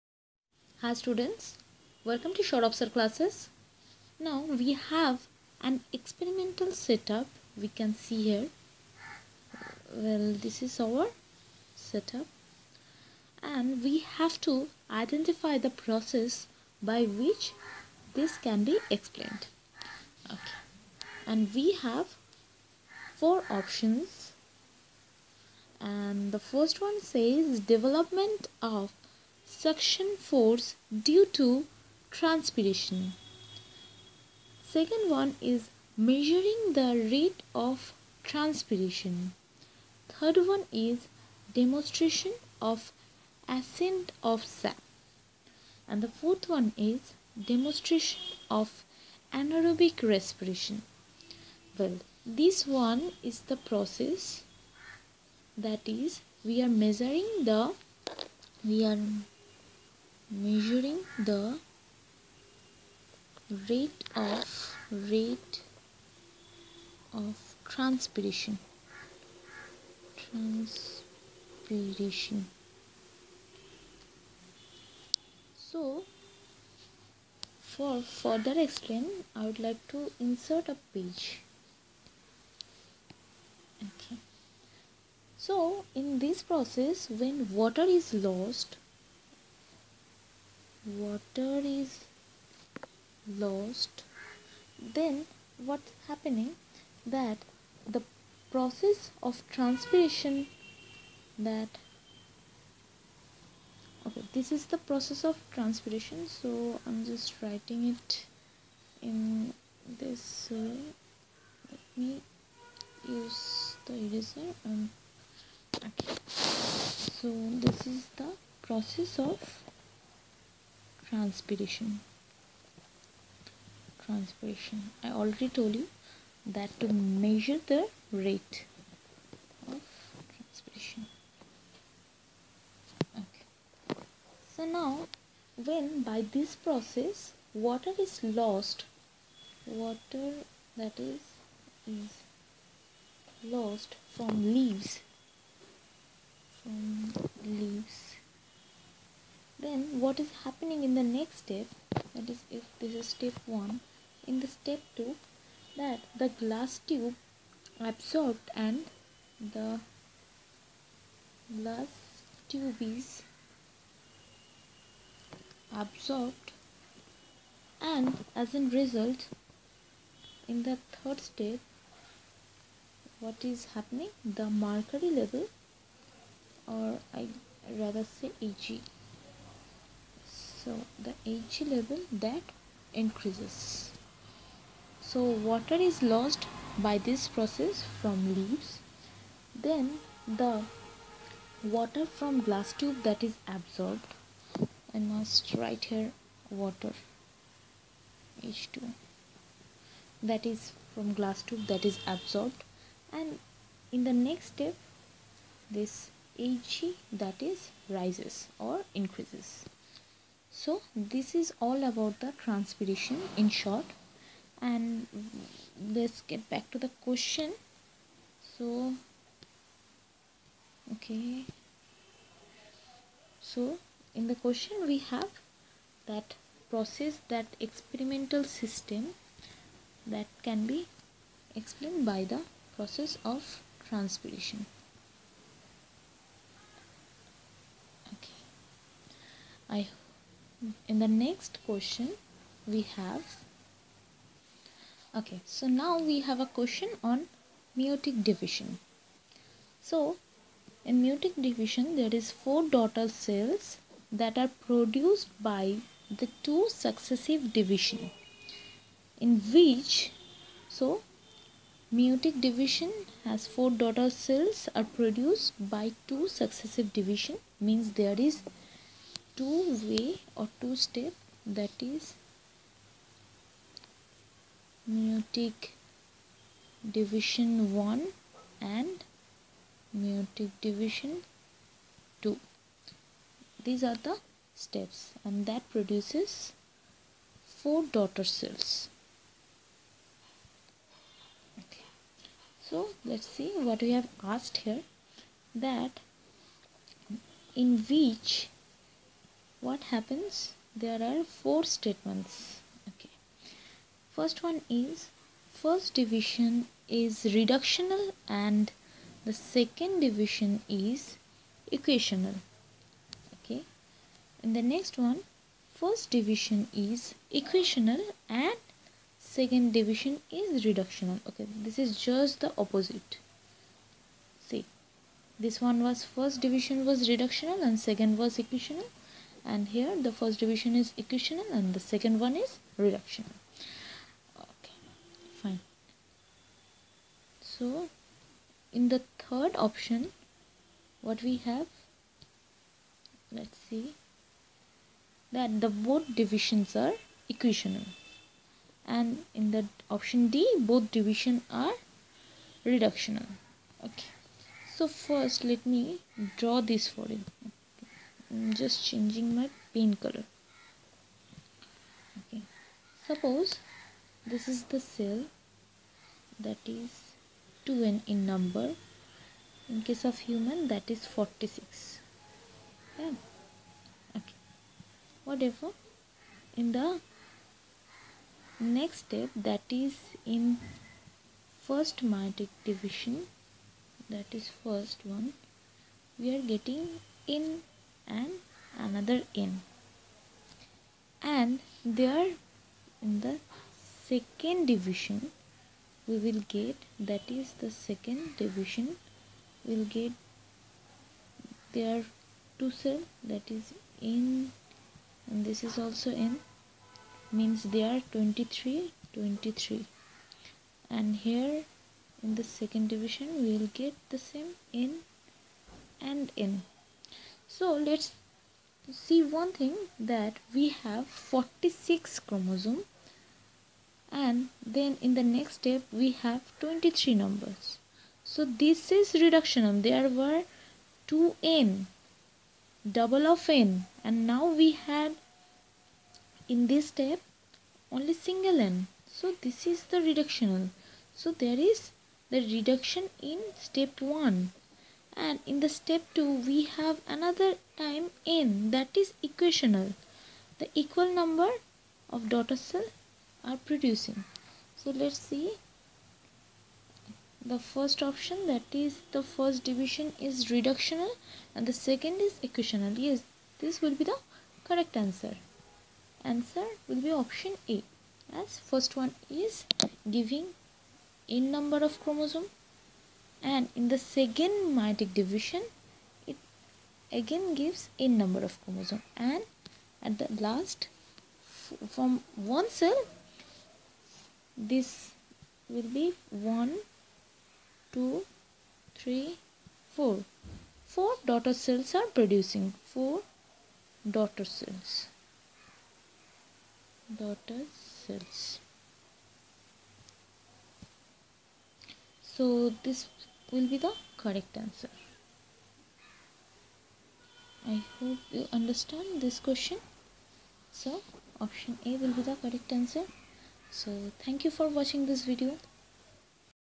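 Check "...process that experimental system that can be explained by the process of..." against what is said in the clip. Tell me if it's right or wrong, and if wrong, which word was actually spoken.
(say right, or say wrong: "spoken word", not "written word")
right.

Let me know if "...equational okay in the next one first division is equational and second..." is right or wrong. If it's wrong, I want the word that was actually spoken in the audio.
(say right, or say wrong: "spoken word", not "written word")
right.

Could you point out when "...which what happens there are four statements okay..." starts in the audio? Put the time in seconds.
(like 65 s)
297 s.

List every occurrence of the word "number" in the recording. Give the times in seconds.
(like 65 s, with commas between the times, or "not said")
368 s, 427 s, 451 s, 471 s, 478 s.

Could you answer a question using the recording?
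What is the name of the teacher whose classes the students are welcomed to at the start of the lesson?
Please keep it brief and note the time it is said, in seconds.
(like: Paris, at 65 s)
Sourav Sir, at 2 s.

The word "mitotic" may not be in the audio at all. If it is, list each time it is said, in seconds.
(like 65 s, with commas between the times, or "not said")
382 s, 474 s.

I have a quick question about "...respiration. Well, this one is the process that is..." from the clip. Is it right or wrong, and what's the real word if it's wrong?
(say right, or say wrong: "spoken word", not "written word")
right.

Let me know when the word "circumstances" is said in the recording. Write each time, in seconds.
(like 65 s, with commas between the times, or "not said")
not said.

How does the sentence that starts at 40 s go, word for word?
Third one is demonstration of ascent of sap.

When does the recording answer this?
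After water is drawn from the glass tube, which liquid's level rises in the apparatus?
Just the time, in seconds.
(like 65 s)
174 s.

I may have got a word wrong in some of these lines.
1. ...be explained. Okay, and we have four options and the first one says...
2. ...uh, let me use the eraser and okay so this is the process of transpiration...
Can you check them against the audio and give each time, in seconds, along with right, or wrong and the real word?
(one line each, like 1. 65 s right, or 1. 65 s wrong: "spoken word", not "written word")
1. 18 s right
2. 110 s right.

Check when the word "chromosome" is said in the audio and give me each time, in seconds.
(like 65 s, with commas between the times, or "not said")
422 s, 472 s, 478 s.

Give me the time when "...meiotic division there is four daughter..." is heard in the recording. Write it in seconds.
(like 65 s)
251 s.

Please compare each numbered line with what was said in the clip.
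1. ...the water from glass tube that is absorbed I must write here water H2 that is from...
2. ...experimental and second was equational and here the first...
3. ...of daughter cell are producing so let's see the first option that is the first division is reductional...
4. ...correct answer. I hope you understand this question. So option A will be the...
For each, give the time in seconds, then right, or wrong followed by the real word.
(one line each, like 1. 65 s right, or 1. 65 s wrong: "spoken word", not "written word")
1. 190 s right
2. 327 s wrong: "reductional", not "experimental"
3. 452 s right
4. 504 s right.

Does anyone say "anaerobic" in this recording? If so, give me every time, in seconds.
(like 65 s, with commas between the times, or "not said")
49 s.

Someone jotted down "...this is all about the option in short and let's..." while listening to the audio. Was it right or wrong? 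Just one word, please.
wrong.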